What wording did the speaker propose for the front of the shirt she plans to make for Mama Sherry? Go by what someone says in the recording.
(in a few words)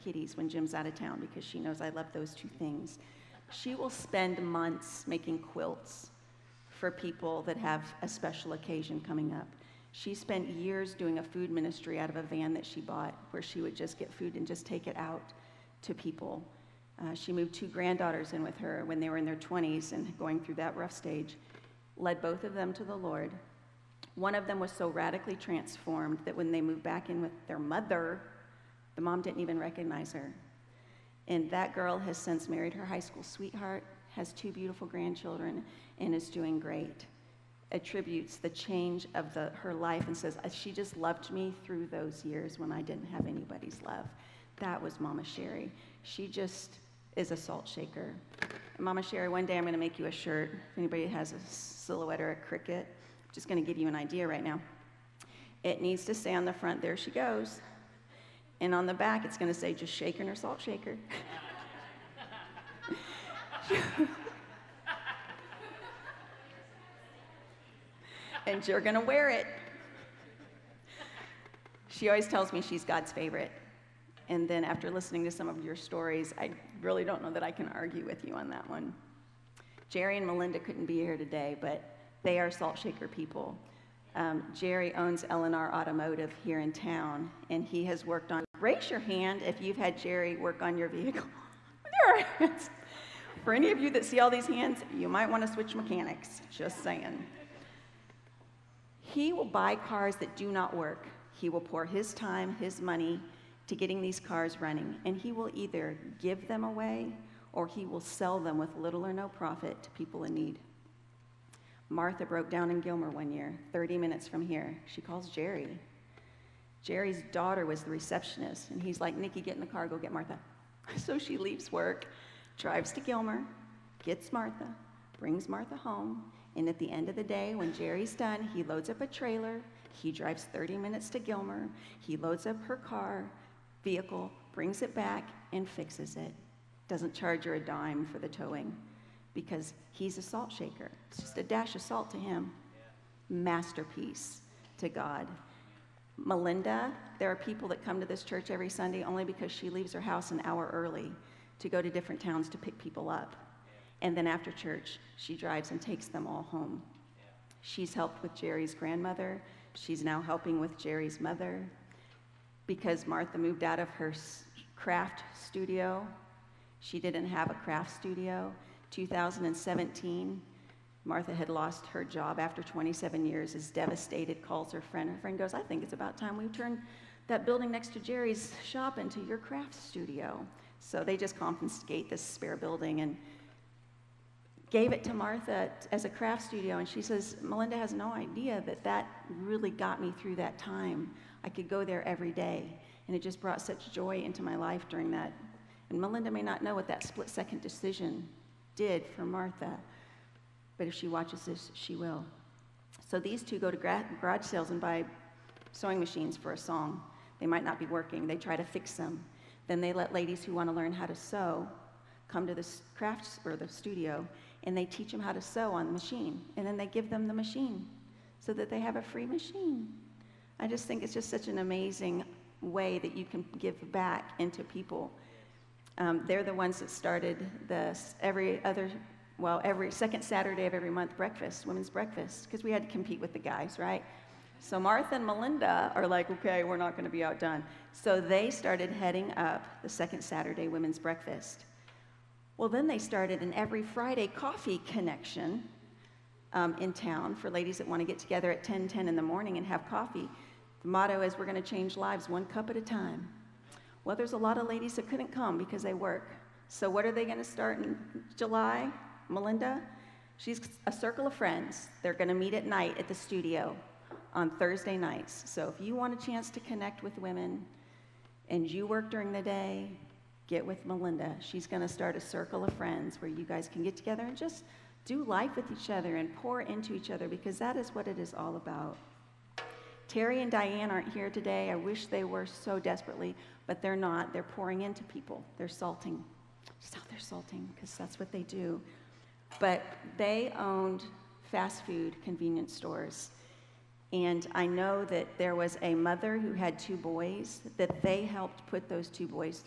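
There she goes.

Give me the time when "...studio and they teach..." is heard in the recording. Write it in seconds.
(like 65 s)
213 s.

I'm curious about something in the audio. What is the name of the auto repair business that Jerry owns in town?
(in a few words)
LNR Automotive.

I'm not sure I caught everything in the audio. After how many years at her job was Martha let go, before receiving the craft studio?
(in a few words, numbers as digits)
27.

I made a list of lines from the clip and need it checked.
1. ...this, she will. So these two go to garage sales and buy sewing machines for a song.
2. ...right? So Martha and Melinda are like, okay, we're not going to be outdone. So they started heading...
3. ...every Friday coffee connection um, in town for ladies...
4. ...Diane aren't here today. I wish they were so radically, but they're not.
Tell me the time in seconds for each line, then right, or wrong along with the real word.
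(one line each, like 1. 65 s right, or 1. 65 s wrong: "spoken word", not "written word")
1. 201 s right
2. 233 s right
3. 243 s right
4. 280 s wrong: "desperately", not "radically".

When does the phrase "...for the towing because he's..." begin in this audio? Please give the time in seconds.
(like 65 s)
138 s.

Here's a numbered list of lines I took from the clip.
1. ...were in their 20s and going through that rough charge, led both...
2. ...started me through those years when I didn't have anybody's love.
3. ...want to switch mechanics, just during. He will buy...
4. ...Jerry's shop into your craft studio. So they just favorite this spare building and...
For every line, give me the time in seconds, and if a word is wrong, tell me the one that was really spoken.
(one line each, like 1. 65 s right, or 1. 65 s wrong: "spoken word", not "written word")
1. 19 s wrong: "stage", not "charge"
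2. 40 s wrong: "loved", not "started"
3. 95 s wrong: "saying", not "during"
4. 177 s wrong: "confiscate", not "favorite".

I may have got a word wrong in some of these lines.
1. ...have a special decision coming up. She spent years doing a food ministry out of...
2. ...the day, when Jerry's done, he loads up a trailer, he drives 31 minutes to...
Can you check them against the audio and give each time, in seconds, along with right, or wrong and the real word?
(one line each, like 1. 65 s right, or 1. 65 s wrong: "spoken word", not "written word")
1. 7 s wrong: "occasion", not "decision"
2. 127 s wrong: "30", not "31".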